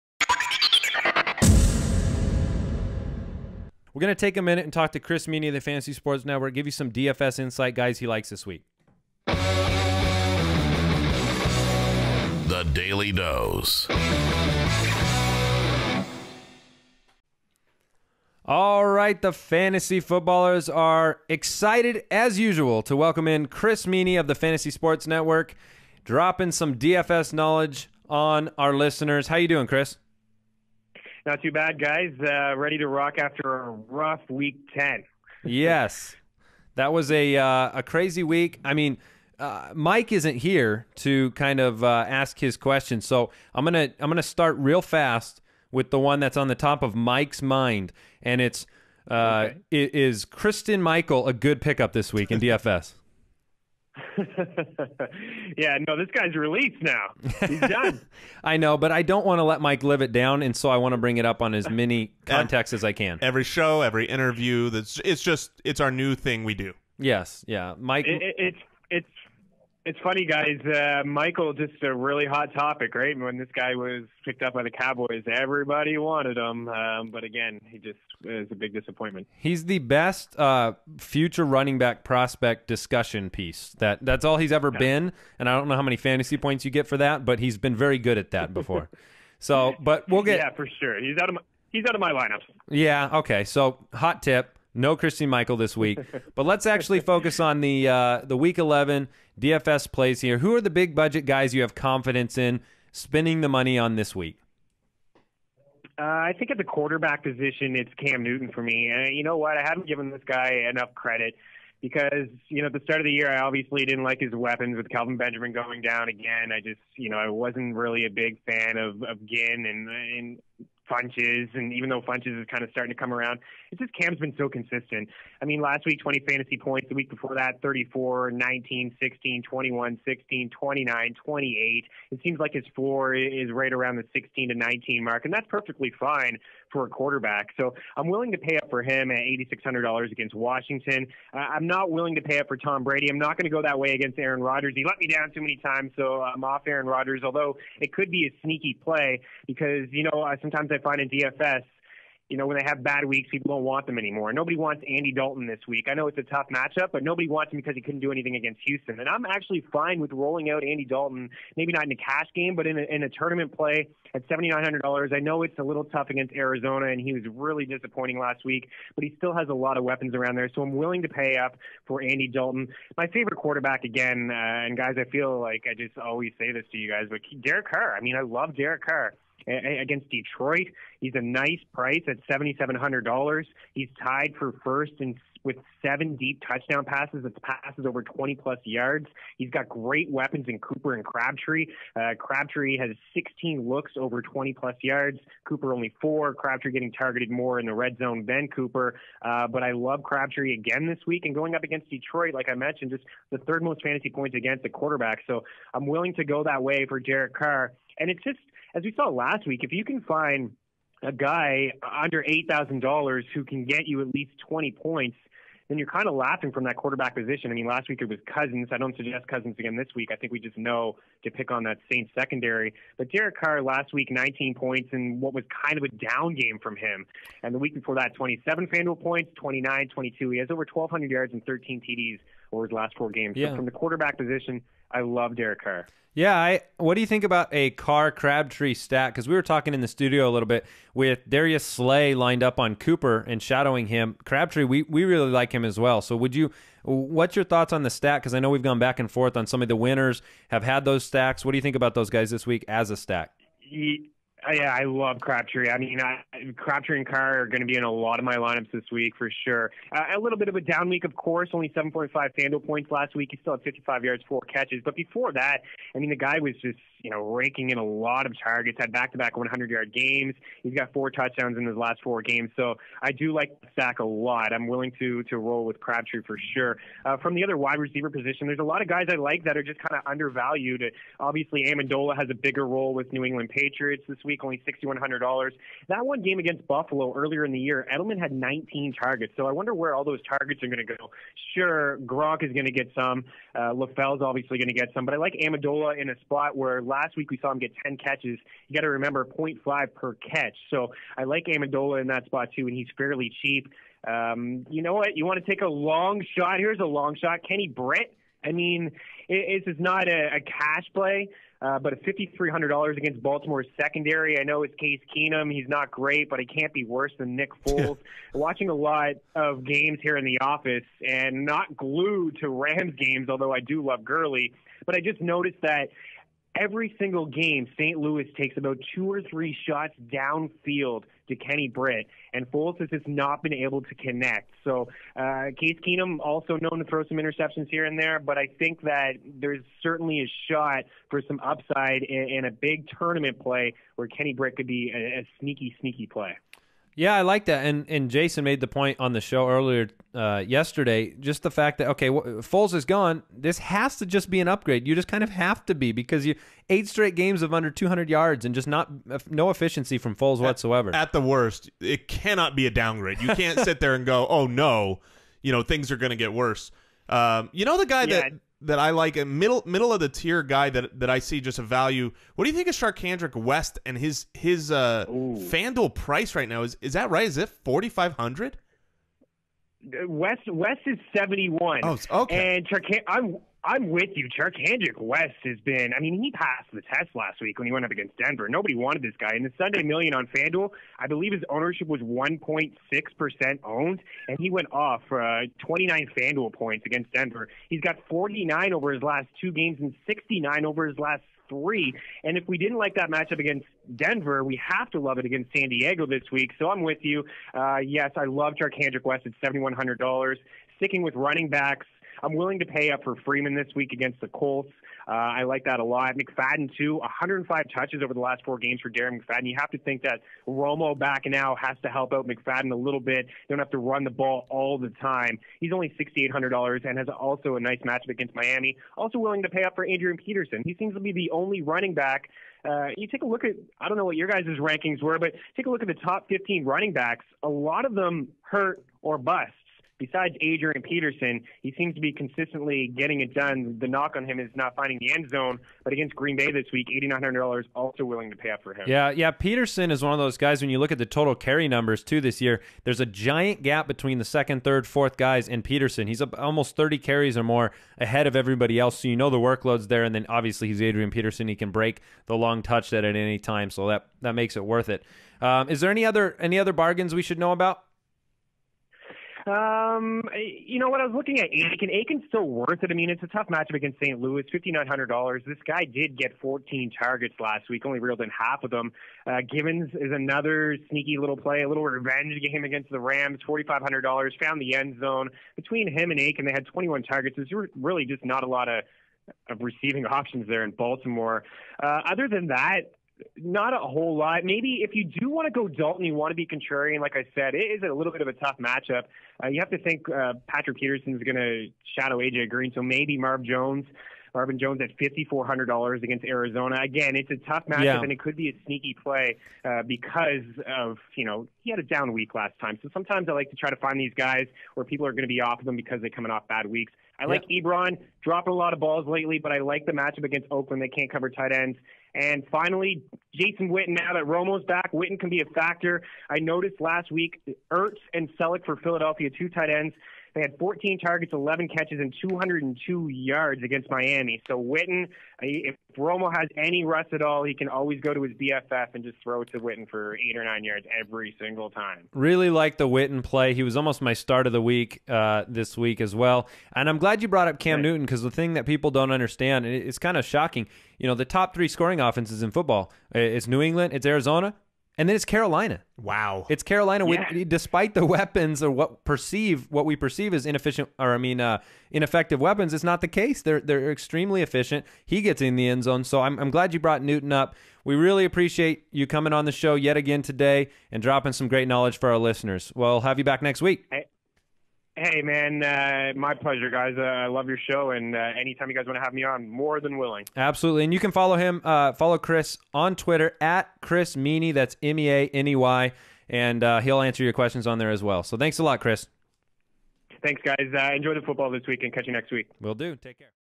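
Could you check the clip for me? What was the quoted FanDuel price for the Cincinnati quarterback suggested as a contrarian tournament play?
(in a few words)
$7,900.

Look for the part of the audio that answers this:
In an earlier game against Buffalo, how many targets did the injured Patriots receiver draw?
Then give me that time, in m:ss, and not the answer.
4:48.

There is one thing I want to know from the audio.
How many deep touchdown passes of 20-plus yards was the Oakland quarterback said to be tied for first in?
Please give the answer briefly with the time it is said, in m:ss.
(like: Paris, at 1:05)
7, at 3:05.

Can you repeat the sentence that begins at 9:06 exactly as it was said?
And I'm glad you brought up Cam right.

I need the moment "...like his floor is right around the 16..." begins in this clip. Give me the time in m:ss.
2:12.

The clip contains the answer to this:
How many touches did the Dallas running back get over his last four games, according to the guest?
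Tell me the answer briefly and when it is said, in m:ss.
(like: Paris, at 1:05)
105, at 6:56.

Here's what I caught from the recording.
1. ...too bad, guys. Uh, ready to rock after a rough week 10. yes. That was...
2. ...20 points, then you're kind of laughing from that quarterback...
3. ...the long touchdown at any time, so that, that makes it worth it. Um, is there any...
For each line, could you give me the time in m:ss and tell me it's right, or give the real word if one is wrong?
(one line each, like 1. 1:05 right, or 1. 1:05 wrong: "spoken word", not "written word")
1. 0:31 right
2. 3:34 right
3. 7:42 right.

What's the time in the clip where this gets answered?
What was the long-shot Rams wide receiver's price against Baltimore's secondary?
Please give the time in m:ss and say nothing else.
5:11.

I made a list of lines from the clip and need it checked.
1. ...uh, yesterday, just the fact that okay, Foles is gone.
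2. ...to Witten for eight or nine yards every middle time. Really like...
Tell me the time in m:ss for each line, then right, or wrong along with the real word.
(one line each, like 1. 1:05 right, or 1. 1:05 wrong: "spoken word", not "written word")
1. 5:50 right
2. 8:59 wrong: "single", not "middle".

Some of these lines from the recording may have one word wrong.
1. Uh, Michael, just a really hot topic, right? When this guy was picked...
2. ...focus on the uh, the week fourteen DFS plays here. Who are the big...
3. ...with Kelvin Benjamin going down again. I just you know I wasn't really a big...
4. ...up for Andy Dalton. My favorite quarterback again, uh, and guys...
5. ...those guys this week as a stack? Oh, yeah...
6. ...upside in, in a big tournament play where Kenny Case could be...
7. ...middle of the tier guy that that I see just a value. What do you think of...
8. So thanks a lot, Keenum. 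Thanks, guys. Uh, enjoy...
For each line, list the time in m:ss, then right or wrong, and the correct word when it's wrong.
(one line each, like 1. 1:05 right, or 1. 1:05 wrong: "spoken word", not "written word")
1. 1:10 right
2. 1:37 wrong: "eleven", not "fourteen"
3. 1:54 right
4. 2:51 right
5. 4:11 right
6. 5:41 wrong: "Britt", not "Case"
7. 6:09 right
8. 9:48 wrong: "Chris", not "Keenum".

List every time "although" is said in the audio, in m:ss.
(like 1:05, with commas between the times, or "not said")
2:27, 5:23.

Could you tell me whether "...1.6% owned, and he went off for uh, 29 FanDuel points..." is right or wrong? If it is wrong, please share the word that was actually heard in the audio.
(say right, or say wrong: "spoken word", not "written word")
right.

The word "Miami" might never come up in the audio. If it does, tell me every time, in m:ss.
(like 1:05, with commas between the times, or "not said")
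7:08, 8:53.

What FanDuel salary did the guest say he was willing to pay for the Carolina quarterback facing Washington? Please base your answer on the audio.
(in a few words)
$8,600.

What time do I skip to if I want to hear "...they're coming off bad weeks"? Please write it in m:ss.
8:35.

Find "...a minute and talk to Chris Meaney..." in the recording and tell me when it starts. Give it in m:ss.
0:04.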